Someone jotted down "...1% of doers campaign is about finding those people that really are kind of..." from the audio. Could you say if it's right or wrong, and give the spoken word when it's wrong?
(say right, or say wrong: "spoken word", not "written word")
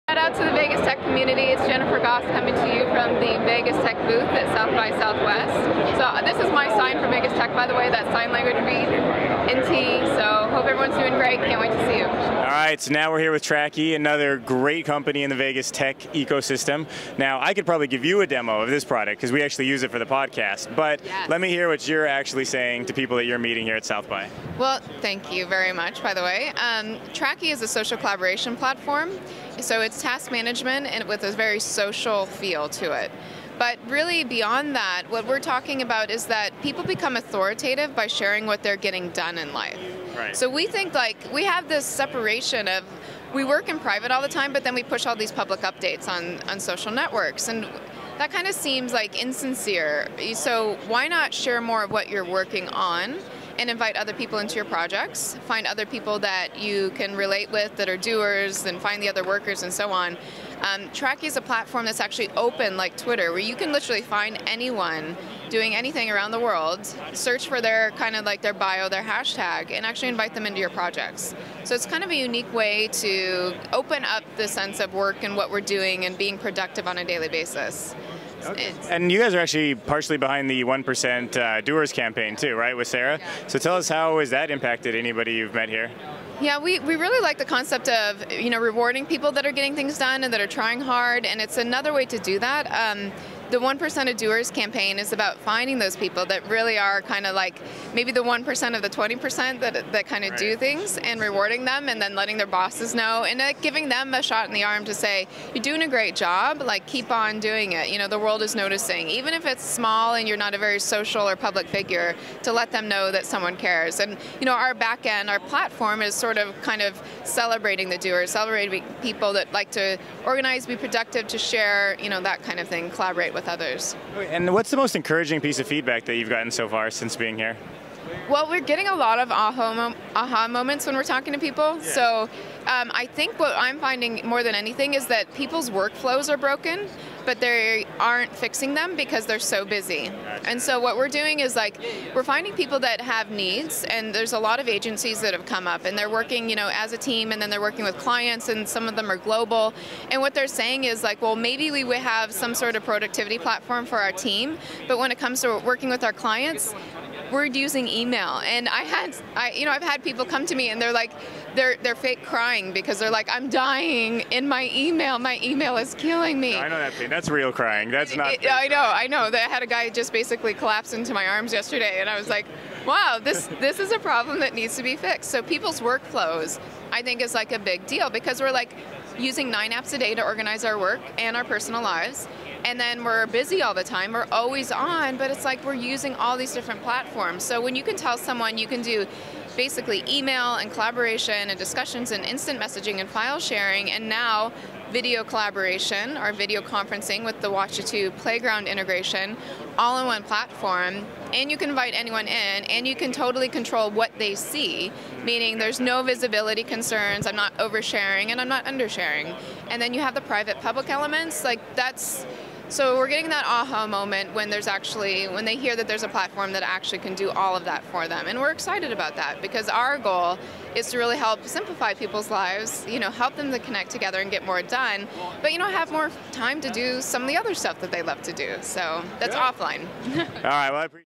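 right.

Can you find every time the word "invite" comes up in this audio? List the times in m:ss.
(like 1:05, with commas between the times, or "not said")
0:53, 1:10, 3:21.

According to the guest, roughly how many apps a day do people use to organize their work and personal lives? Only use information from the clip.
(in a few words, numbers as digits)
9.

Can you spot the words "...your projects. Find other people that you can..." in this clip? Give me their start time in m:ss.
0:54.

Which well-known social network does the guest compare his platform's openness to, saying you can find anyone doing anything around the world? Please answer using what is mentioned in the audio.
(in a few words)
Twitter.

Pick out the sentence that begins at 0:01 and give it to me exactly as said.
It's Jennifer Gosse coming to you from the Vegas Tech booth at South by Southwest.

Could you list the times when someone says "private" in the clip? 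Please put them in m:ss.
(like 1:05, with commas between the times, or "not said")
0:43, 3:30.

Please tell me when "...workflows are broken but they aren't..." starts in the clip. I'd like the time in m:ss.
2:15.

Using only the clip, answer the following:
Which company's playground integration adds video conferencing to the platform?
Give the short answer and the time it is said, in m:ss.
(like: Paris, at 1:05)
Watchitoo, at 3:17.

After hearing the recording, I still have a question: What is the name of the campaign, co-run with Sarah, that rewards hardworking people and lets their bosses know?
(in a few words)
1% Doers.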